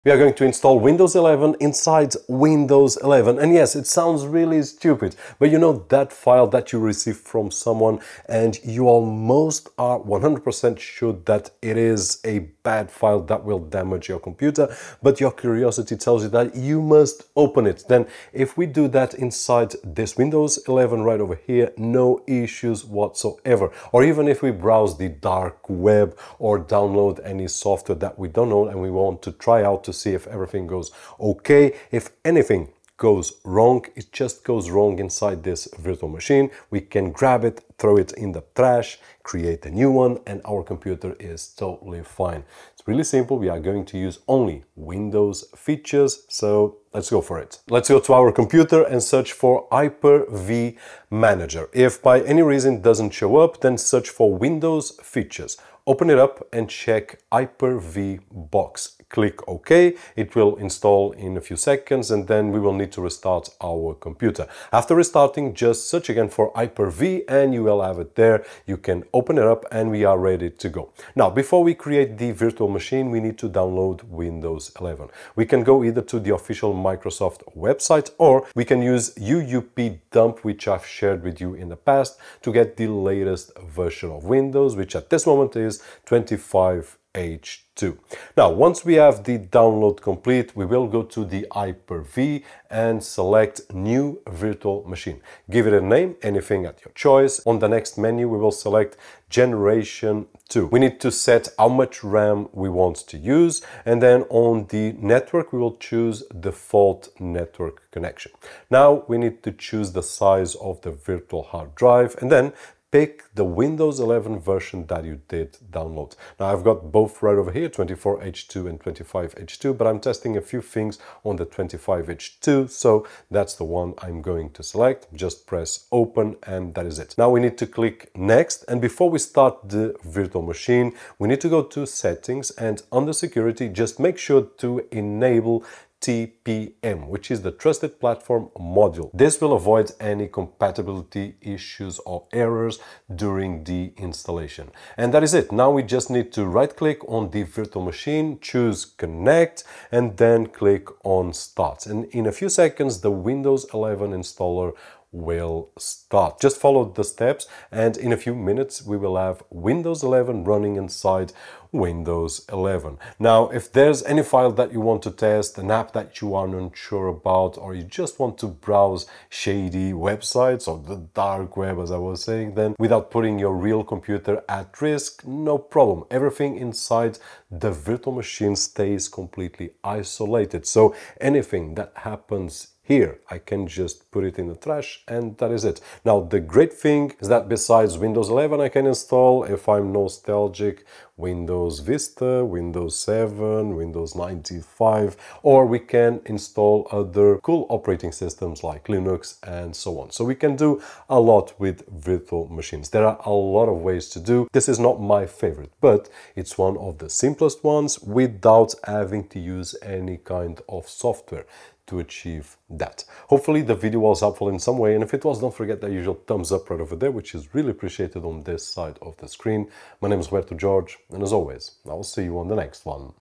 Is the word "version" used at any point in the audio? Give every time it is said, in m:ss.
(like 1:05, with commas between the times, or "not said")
1:23, 1:54.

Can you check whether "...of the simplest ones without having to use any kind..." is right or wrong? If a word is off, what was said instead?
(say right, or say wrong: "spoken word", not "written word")
right.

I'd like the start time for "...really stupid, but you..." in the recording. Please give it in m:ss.
0:04.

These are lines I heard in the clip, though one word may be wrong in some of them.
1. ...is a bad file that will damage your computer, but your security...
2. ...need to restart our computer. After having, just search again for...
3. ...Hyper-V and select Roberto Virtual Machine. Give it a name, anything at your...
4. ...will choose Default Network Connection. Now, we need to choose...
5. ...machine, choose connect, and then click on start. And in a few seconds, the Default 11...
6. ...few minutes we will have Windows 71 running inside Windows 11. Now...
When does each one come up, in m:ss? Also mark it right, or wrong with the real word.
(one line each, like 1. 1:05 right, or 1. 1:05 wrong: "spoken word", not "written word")
1. 0:11 wrong: "curiosity", not "security"
2. 1:02 wrong: "restarting", not "having"
3. 1:31 wrong: "New", not "Roberto"
4. 1:45 right
5. 2:27 wrong: "Windows", not "Default"
6. 2:38 wrong: "11", not "71".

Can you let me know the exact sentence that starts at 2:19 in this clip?
This will avoid any compatibility issues or errors during the installation.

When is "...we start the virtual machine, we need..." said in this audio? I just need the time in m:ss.
2:09.